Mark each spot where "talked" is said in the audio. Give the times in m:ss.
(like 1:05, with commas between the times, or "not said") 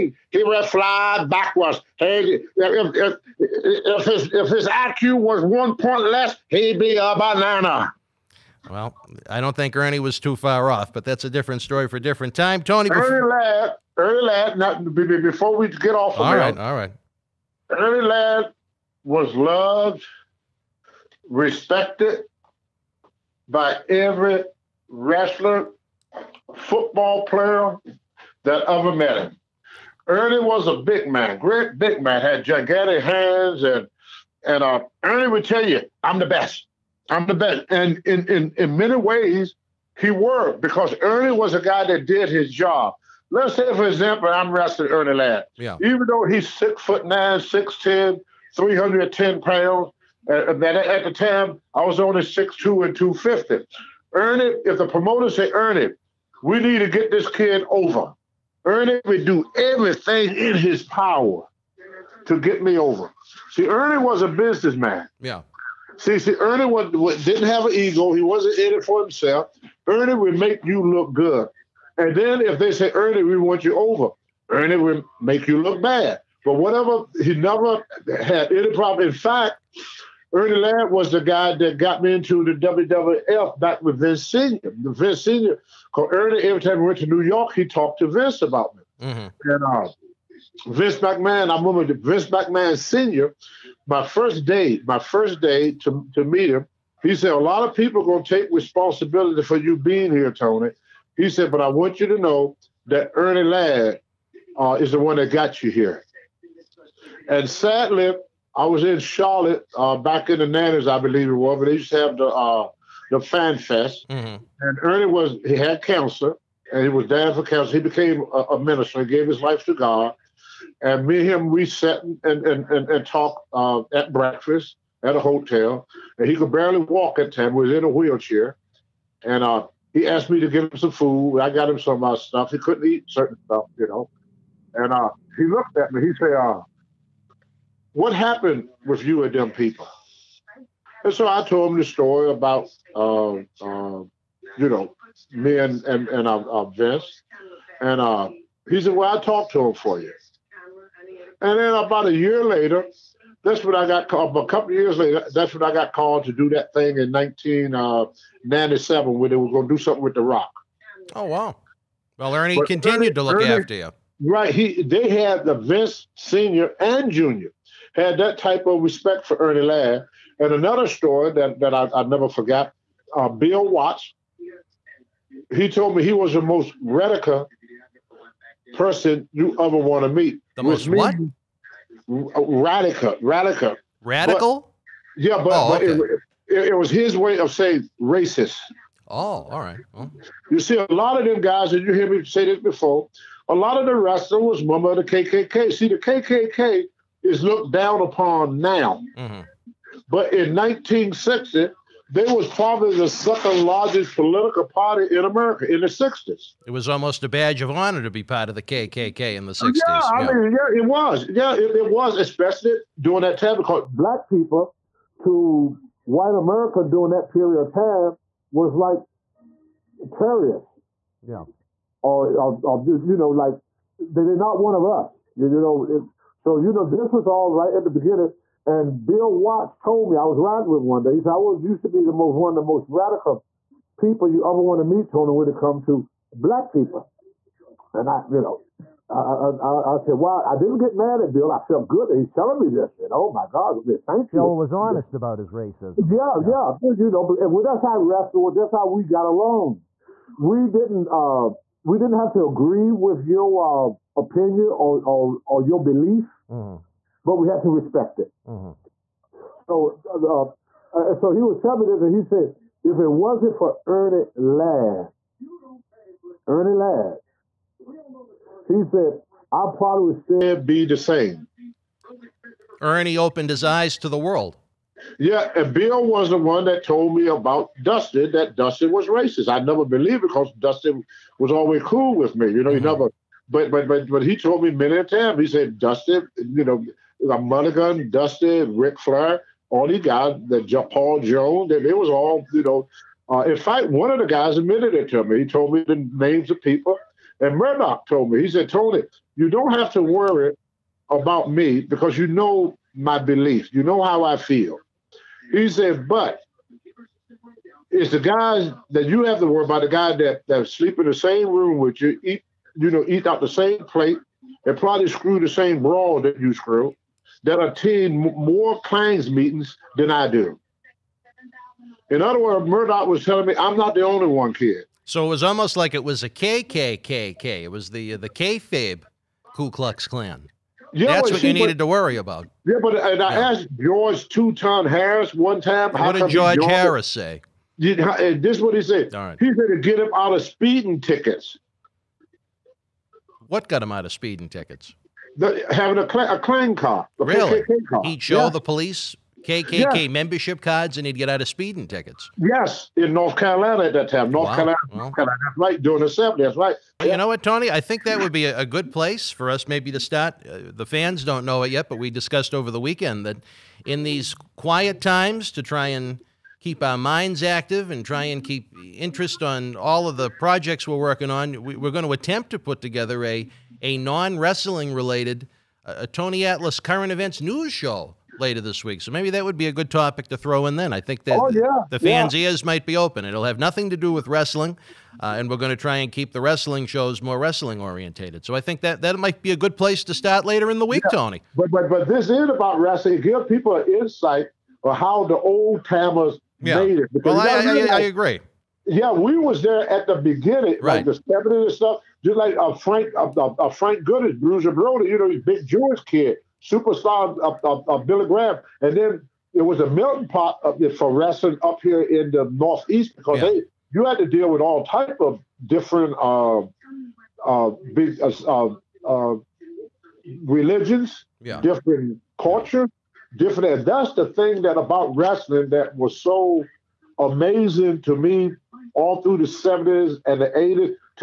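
1:27, 2:03, 2:29.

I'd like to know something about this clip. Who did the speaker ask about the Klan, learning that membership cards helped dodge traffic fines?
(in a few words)
George Two Ton Harris.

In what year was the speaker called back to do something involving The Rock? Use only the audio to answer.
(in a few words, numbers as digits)
1997.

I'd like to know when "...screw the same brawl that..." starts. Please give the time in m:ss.
5:15.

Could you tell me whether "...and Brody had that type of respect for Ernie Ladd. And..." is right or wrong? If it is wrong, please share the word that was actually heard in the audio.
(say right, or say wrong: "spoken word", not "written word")
wrong: "Junior", not "Brody".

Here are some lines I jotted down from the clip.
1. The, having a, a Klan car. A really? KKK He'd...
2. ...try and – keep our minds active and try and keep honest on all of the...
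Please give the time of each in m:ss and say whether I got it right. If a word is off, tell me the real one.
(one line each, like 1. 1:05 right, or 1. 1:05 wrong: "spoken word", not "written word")
1. 5:45 right
2. 6:05 wrong: "interest", not "honest".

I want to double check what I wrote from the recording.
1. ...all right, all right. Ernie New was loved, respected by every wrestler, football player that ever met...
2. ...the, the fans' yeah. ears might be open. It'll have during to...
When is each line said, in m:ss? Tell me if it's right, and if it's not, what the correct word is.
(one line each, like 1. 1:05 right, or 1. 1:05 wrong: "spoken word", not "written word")
1. 0:16 wrong: "Ladd", not "New"
2. 6:21 wrong: "nothing", not "during".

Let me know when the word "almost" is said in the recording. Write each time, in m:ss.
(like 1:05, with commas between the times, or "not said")
3:26, 5:25.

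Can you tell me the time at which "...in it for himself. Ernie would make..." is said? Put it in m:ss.
1:08.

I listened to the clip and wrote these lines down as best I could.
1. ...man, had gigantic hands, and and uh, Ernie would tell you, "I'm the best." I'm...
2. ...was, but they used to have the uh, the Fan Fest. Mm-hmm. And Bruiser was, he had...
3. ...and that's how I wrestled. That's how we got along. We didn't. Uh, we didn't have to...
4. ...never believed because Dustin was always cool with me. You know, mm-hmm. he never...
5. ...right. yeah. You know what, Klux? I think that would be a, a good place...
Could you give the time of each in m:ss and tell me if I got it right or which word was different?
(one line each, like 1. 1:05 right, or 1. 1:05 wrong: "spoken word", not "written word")
1. 0:32 right
2. 1:51 wrong: "Ernie", not "Bruiser"
3. 4:07 right
4. 4:39 right
5. 5:56 wrong: "Tony", not "Klux".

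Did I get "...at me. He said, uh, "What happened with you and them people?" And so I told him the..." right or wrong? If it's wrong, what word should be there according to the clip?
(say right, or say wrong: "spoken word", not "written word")
right.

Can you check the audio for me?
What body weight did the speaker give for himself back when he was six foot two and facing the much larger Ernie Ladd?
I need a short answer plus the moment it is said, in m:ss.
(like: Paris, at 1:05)
250, at 0:52.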